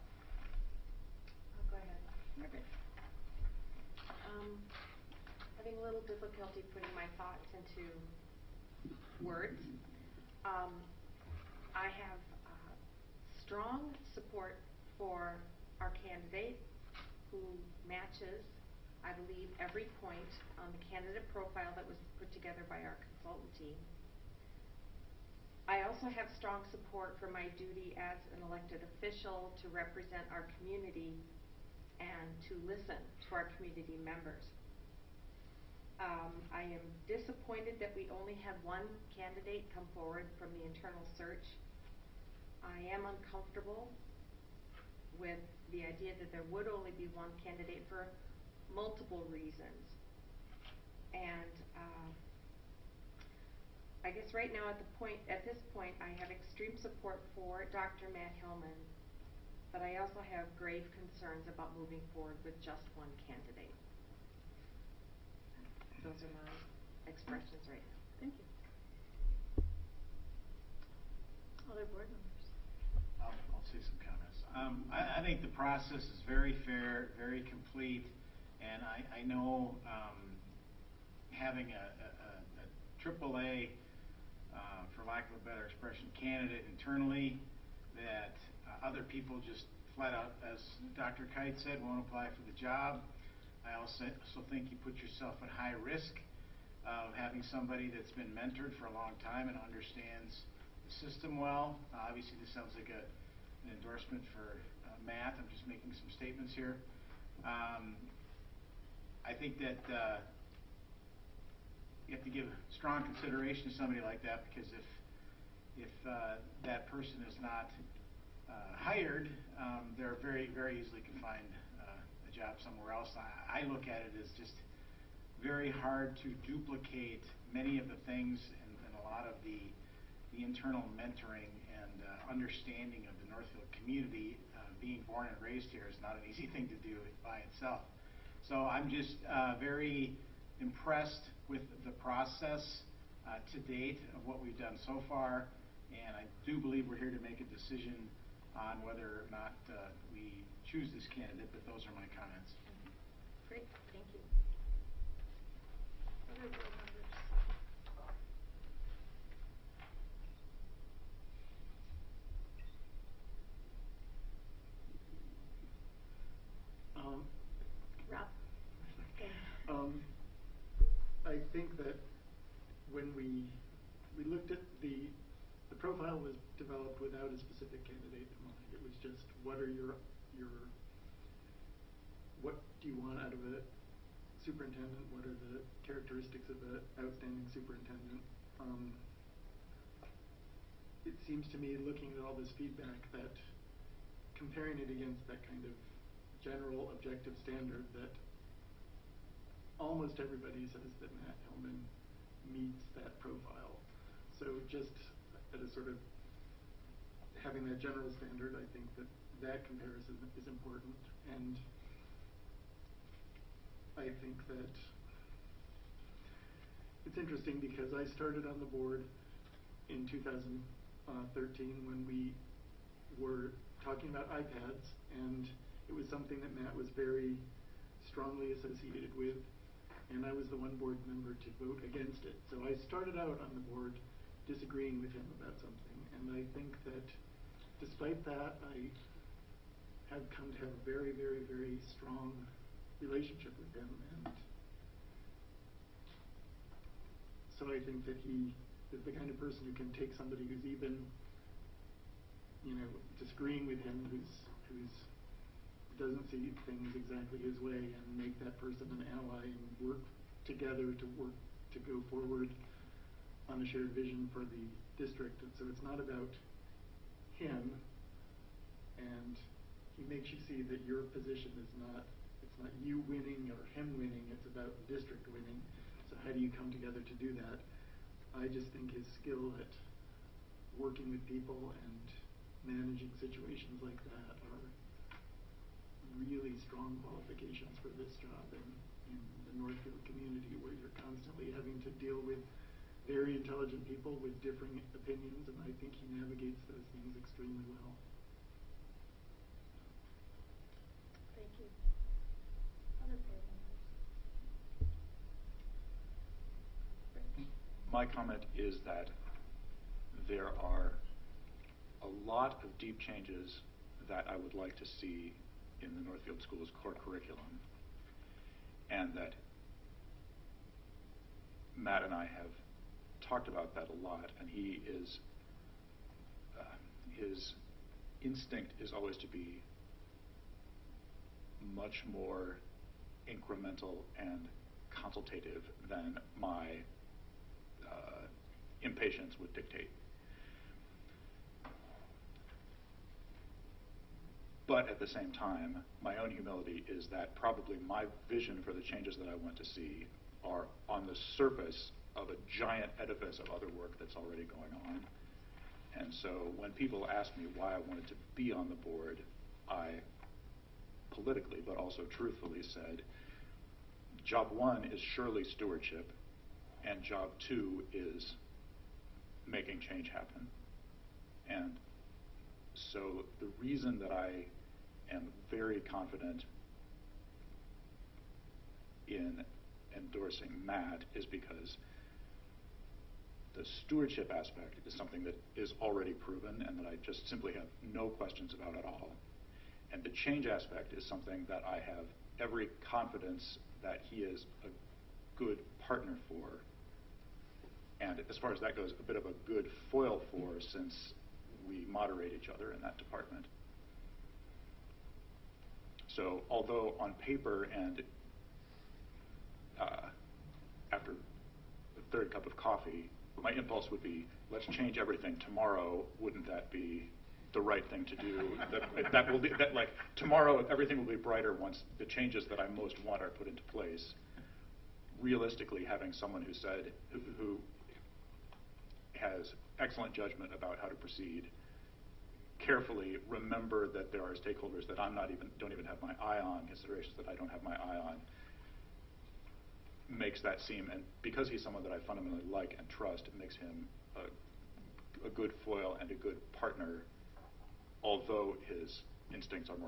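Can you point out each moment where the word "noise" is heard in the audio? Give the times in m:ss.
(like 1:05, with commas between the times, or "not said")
not said.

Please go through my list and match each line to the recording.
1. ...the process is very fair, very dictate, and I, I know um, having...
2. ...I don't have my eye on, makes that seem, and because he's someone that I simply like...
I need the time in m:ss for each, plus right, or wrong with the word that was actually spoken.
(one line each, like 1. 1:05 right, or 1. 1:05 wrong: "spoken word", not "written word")
1. 1:15 wrong: "complete", not "dictate"
2. 7:17 wrong: "fundamentally", not "simply".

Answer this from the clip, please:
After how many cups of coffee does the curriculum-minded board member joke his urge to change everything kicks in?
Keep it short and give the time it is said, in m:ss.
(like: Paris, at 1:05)
third, at 6:52.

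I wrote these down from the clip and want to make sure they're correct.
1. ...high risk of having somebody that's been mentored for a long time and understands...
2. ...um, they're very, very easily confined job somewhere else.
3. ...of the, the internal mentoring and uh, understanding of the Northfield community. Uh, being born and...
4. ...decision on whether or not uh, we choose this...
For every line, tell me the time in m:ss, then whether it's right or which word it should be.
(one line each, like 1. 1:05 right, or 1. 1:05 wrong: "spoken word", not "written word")
1. 1:35 right
2. 1:59 right
3. 2:09 right
4. 2:27 right.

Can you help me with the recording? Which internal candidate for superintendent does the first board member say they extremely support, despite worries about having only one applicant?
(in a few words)
Dr. Matt Hillman.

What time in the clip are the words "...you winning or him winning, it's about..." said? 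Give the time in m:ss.
4:32.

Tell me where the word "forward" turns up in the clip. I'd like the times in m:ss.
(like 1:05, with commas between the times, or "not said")
0:39, 1:02, 4:22.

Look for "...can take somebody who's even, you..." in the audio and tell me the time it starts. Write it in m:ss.
4:09.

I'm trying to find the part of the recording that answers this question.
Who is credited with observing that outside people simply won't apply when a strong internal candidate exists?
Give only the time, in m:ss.
1:30.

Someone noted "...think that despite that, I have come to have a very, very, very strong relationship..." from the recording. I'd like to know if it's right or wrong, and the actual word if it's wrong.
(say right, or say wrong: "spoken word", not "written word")
right.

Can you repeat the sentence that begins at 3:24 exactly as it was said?
So just at a sort of having that general standard, I think that that comparison is important.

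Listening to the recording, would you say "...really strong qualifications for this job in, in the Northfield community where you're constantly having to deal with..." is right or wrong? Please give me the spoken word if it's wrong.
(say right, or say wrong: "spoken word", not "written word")
right.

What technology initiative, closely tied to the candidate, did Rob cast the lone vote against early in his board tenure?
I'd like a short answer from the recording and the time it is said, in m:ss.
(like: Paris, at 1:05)
iPads, at 3:44.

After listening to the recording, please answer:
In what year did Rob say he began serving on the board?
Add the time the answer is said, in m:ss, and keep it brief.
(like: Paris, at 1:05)
2013, at 3:40.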